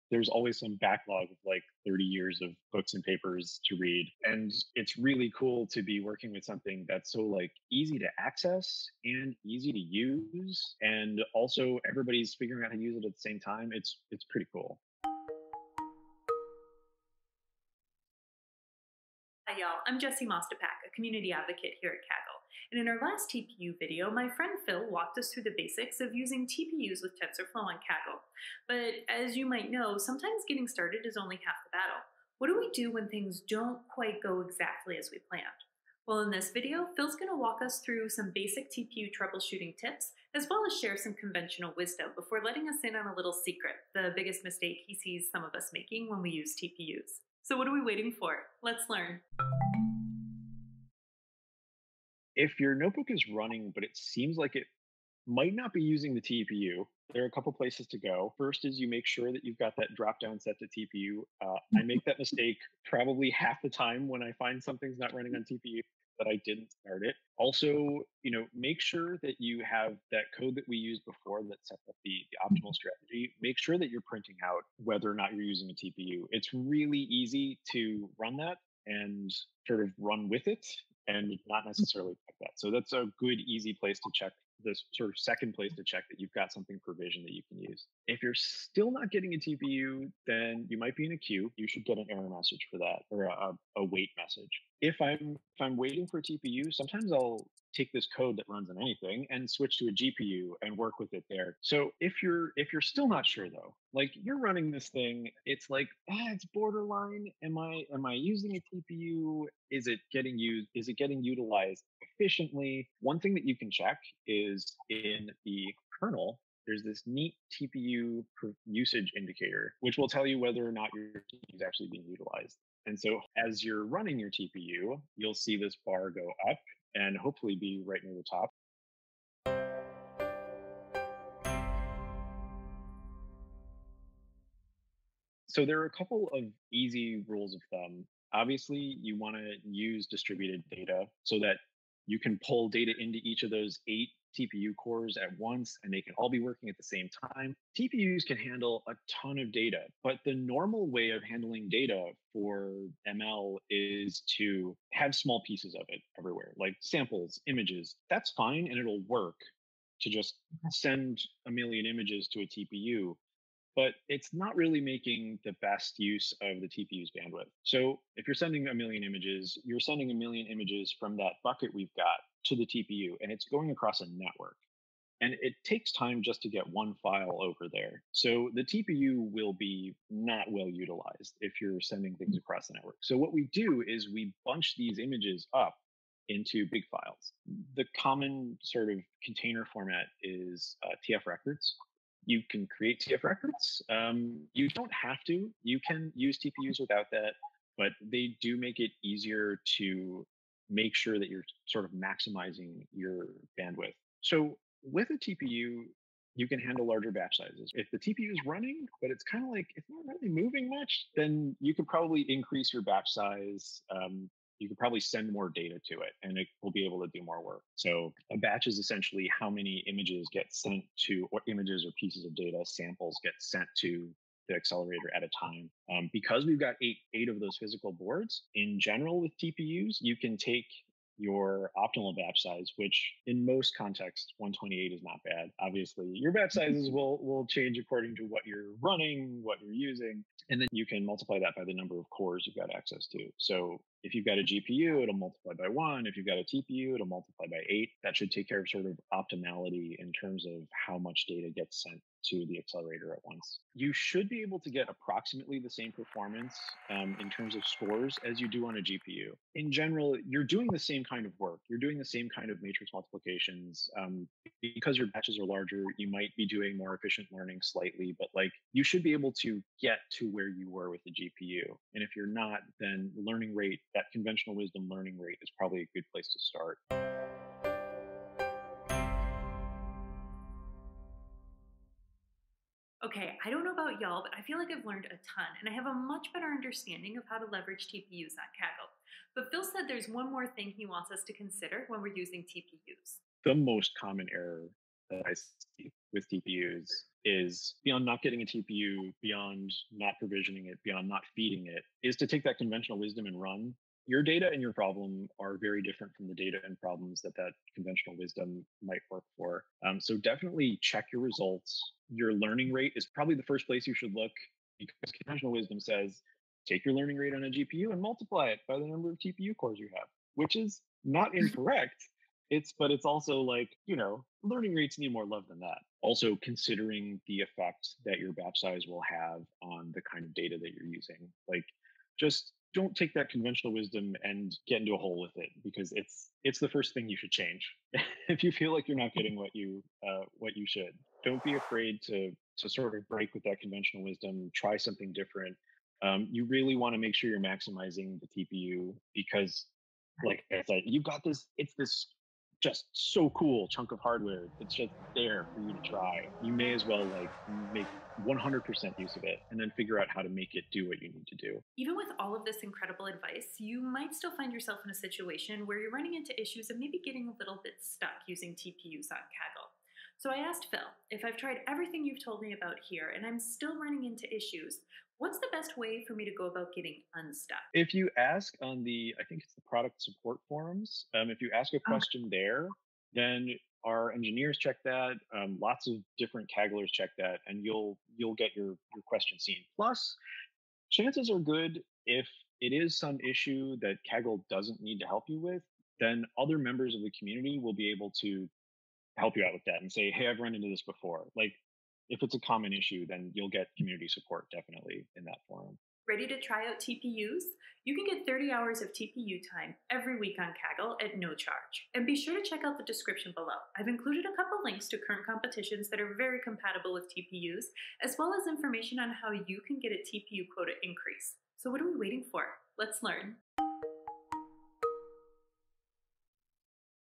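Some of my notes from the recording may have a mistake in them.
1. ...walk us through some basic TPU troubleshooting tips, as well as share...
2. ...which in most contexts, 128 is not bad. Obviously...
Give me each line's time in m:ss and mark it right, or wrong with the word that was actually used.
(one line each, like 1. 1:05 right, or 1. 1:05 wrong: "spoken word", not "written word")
1. 0:37 right
2. 3:52 right.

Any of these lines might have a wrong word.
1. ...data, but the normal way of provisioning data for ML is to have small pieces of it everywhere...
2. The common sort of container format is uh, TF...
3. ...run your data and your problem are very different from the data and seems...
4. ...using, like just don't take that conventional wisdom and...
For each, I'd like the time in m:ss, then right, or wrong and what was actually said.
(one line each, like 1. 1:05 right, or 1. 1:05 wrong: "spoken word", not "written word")
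1. 2:29 wrong: "handling", not "provisioning"
2. 3:07 right
3. 5:03 wrong: "problems", not "seems"
4. 5:30 right.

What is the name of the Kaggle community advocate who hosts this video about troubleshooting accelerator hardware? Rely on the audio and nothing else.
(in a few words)
Jesse Mostipak.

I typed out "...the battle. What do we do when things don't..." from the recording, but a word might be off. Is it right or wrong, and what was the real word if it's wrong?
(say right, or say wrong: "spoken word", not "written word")
right.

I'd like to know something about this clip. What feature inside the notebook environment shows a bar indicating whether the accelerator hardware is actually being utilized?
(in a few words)
TPU usage indicator.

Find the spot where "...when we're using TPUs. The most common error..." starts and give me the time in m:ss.
4:51.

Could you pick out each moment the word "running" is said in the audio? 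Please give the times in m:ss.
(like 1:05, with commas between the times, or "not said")
0:53, 1:05, 1:44, 2:03, 3:28, 3:58, 6:05, 6:13.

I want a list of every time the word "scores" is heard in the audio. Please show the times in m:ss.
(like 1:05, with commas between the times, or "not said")
4:17.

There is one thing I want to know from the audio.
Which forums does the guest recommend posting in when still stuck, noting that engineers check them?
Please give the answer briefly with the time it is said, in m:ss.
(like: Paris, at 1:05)
product support forums, at 6:19.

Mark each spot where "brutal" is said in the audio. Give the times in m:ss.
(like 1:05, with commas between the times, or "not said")
not said.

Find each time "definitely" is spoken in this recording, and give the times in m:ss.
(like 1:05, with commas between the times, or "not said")
5:10, 6:44.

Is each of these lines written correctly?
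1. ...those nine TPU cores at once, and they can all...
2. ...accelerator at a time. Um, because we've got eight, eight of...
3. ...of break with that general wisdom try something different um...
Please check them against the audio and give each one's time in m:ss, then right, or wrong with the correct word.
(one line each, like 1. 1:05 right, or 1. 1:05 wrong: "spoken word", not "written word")
1. 2:23 wrong: "eight", not "nine"
2. 3:44 right
3. 5:42 wrong: "conventional", not "general".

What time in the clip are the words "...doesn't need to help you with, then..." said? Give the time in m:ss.
6:34.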